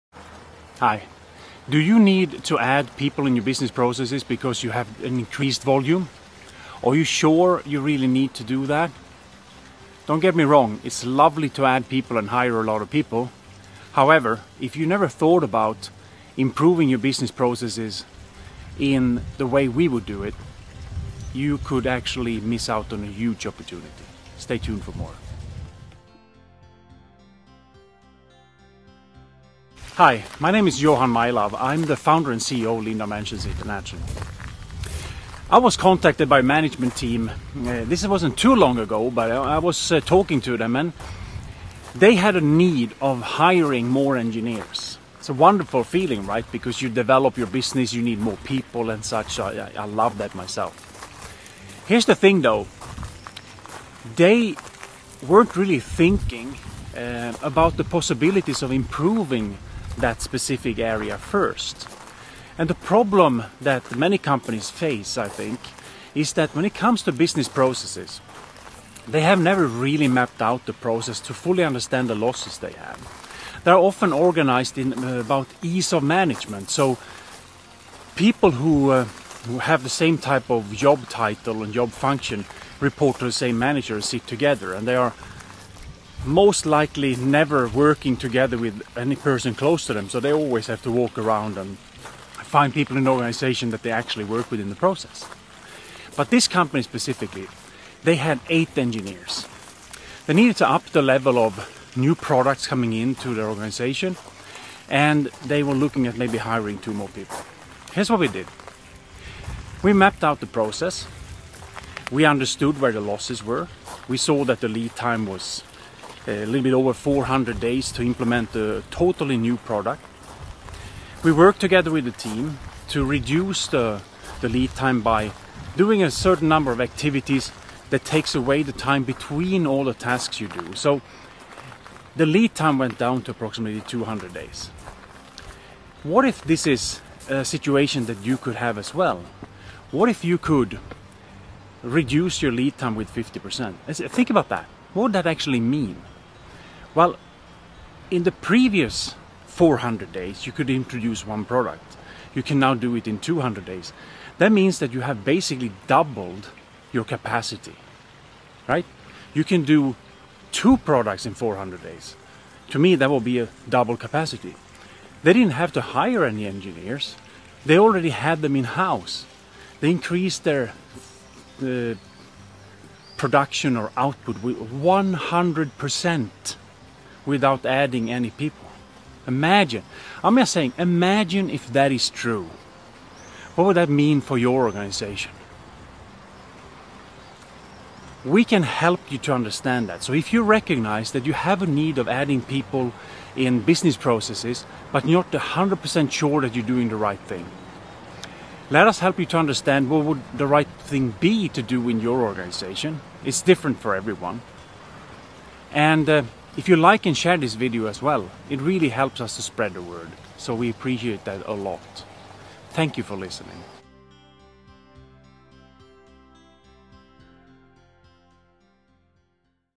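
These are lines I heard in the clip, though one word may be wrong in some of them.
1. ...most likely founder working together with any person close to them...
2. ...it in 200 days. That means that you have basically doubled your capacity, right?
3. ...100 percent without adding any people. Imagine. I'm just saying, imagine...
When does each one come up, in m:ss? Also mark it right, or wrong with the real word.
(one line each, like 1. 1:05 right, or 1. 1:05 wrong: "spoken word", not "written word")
1. 1:26 wrong: "never", not "founder"
2. 2:32 right
3. 2:54 right.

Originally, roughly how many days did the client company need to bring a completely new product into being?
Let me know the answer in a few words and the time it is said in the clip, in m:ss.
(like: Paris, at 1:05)
400, at 1:56.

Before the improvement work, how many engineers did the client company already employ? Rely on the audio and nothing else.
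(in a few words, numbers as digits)
8.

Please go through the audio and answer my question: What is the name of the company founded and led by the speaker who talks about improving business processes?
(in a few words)
Lean Dimensions International.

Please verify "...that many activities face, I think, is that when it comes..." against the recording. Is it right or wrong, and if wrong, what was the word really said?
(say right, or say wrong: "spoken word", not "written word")
wrong: "companies", not "activities".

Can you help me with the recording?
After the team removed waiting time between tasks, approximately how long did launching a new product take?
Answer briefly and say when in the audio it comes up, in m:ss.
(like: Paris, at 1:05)
200 days, at 2:13.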